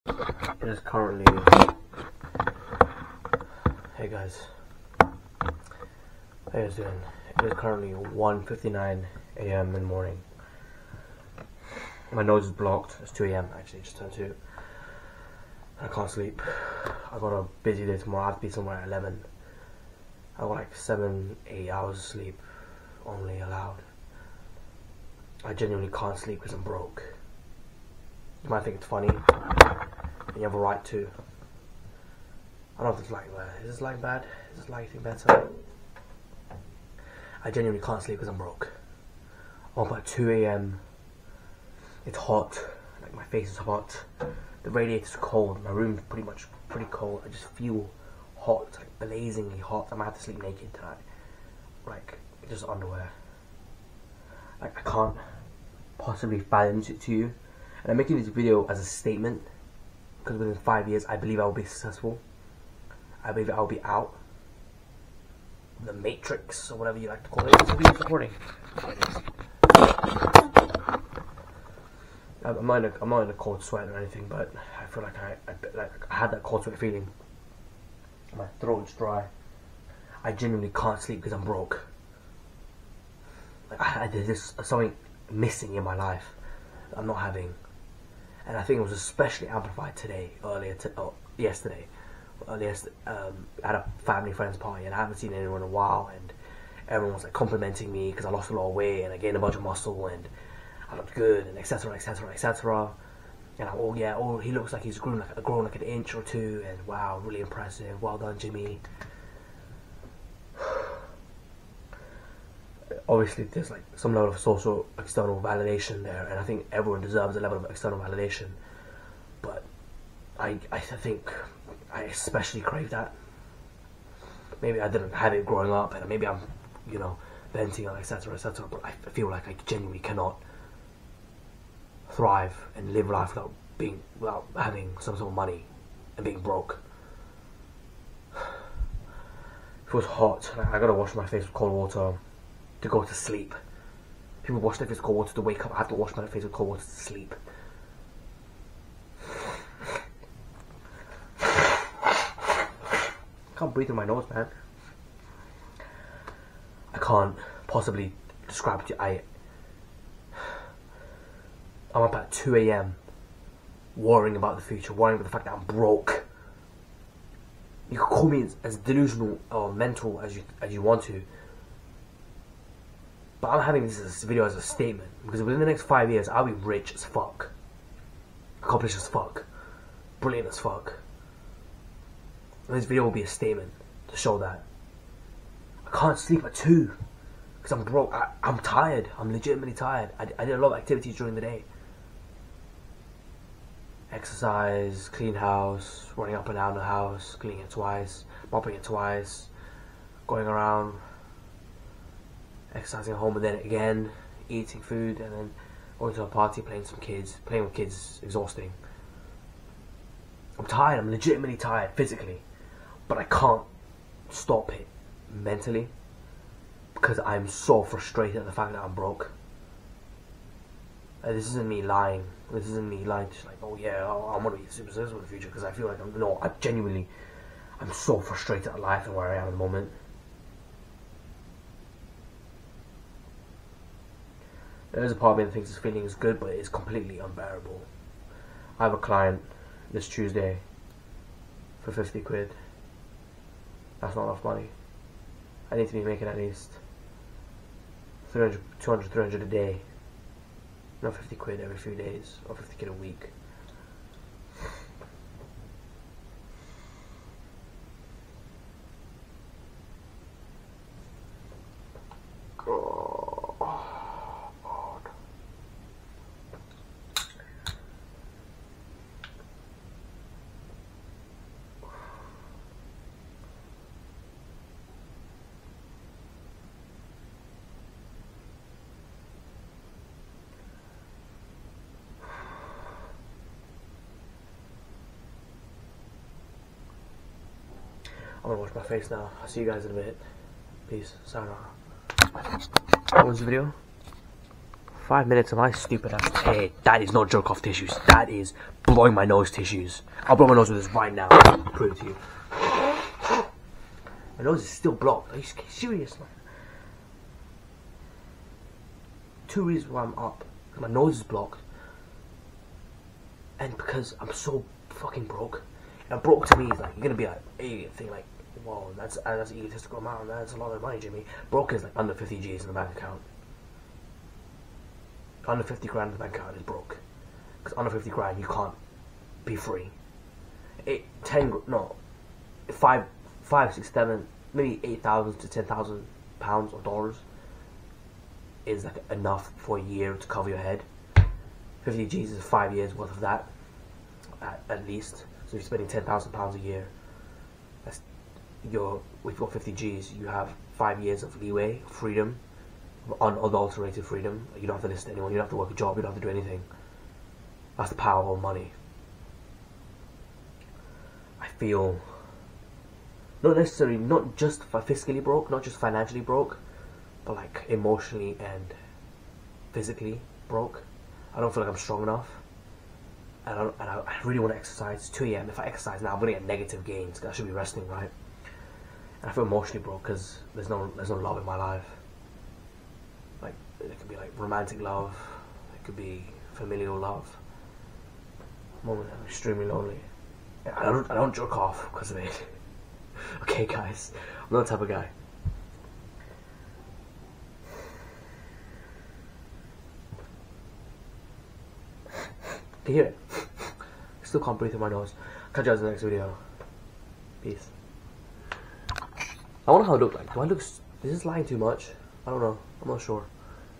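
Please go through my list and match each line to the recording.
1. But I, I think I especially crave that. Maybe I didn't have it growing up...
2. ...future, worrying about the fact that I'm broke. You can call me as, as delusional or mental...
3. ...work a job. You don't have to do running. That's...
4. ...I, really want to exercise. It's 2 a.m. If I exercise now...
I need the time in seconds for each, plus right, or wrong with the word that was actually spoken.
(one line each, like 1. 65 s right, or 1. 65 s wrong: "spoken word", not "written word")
1. 119 s right
2. 164 s right
3. 355 s wrong: "anything", not "running"
4. 374 s right.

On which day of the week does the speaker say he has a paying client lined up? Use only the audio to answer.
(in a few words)
Tuesday.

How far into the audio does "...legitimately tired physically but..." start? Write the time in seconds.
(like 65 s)
211 s.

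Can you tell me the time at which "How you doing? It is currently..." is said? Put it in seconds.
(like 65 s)
4 s.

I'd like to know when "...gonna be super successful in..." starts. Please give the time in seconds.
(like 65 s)
224 s.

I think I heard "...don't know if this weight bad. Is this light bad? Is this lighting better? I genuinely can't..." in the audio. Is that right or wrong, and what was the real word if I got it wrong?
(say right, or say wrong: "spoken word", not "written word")
wrong: "light", not "weight".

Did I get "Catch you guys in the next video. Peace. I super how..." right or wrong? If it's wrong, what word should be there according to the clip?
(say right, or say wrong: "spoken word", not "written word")
wrong: "wonder", not "super".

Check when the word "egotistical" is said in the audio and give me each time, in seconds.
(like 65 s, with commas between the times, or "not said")
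319 s.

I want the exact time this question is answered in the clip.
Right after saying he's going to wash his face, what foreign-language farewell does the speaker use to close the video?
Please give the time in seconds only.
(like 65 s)
291 s.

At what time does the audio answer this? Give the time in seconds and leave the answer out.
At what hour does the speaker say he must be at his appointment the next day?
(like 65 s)
18 s.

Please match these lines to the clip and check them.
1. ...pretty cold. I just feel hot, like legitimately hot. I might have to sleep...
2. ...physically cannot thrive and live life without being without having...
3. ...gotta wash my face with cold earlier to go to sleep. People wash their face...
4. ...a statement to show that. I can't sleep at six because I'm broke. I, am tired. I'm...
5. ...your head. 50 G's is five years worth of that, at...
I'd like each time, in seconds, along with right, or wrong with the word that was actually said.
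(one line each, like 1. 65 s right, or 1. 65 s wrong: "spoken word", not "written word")
1. 46 s wrong: "blazingly", not "legitimately"
2. 129 s wrong: "genuinely", not "physically"
3. 140 s wrong: "water", not "earlier"
4. 183 s wrong: "two", not "six"
5. 340 s right.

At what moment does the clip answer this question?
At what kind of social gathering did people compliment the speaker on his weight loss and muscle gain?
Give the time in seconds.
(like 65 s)
93 s.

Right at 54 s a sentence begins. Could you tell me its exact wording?
Like I can't possibly balance it to you.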